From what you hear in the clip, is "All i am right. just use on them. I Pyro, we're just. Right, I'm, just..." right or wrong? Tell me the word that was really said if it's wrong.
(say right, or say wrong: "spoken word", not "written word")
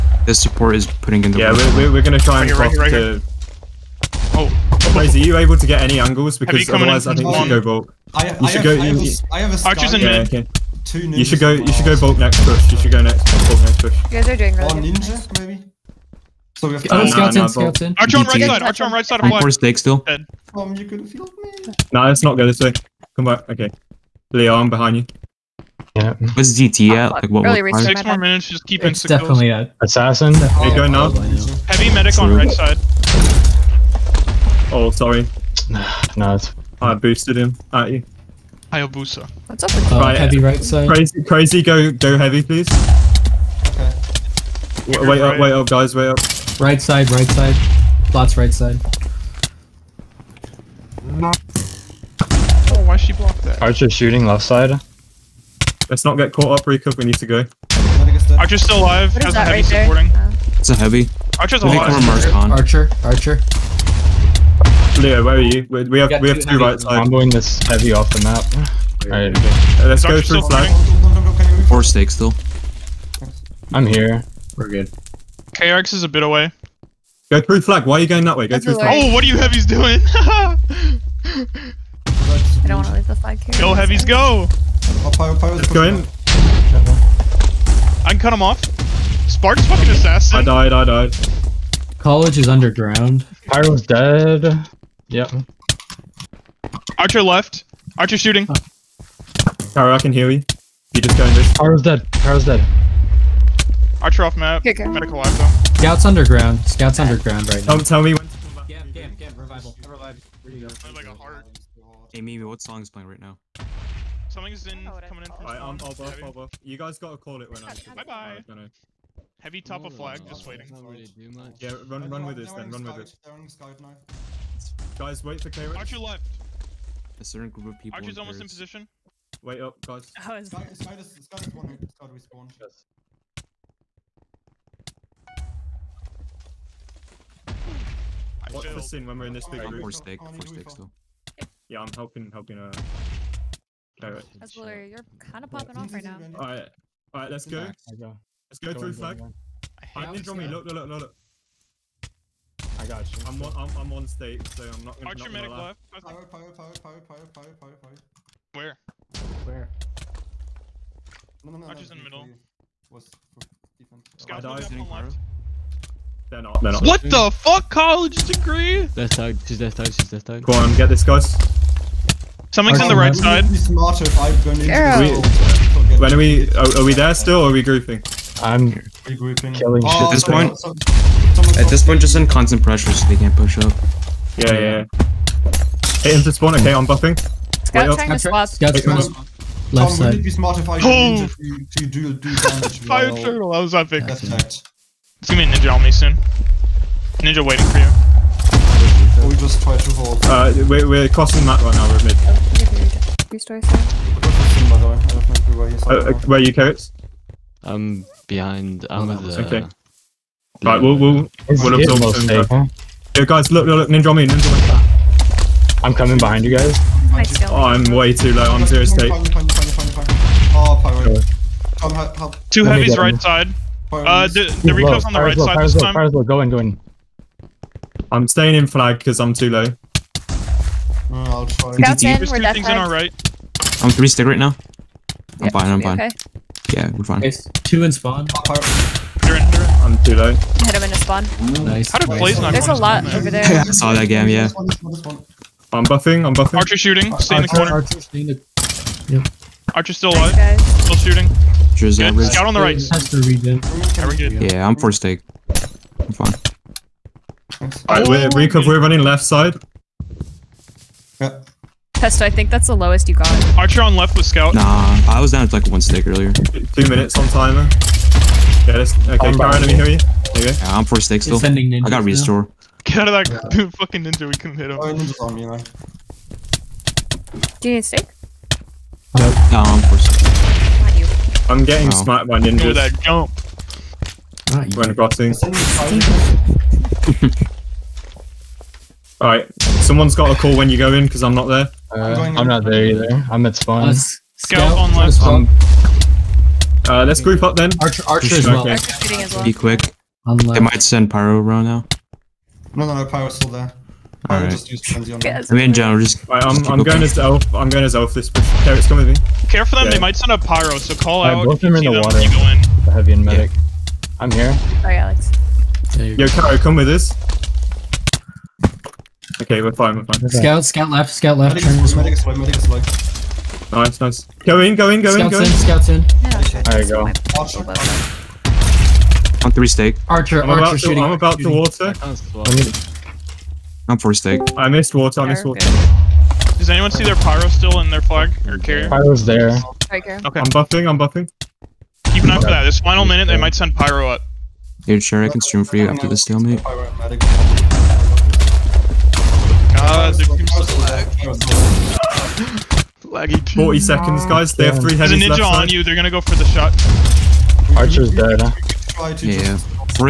wrong: "John", not "Pyro".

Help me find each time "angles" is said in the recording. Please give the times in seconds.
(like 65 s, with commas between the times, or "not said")
5 s.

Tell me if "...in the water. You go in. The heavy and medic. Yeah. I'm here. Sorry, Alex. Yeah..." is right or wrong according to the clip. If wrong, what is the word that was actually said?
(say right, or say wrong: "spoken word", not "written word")
right.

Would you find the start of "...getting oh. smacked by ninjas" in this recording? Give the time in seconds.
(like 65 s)
281 s.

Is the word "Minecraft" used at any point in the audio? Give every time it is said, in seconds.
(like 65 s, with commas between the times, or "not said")
not said.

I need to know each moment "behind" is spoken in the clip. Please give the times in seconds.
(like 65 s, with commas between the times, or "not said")
24 s, 208 s, 216 s.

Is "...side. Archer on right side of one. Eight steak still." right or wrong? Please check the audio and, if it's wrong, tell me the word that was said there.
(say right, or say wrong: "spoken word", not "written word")
wrong: "Four", not "Eight".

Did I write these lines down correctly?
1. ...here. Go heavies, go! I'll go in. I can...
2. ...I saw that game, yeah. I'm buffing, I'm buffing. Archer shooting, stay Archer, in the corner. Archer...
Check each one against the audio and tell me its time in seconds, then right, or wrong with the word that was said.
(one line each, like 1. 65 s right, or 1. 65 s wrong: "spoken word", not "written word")
1. 83 s right
2. 243 s right.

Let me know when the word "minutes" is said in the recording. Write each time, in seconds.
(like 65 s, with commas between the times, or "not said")
28 s, 266 s, 343 s.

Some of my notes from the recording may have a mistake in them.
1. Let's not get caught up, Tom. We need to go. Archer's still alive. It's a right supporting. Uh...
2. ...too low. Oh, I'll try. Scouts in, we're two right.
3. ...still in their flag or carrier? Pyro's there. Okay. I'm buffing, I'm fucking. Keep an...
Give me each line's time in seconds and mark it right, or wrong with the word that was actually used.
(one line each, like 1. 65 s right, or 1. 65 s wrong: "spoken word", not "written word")
1. 55 s wrong: "Rika", not "Tom"
2. 229 s right
3. 337 s wrong: "buffing", not "fucking".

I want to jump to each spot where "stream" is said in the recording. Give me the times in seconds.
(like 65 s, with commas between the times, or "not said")
345 s.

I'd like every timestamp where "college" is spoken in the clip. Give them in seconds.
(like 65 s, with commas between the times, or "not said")
91 s, 167 s.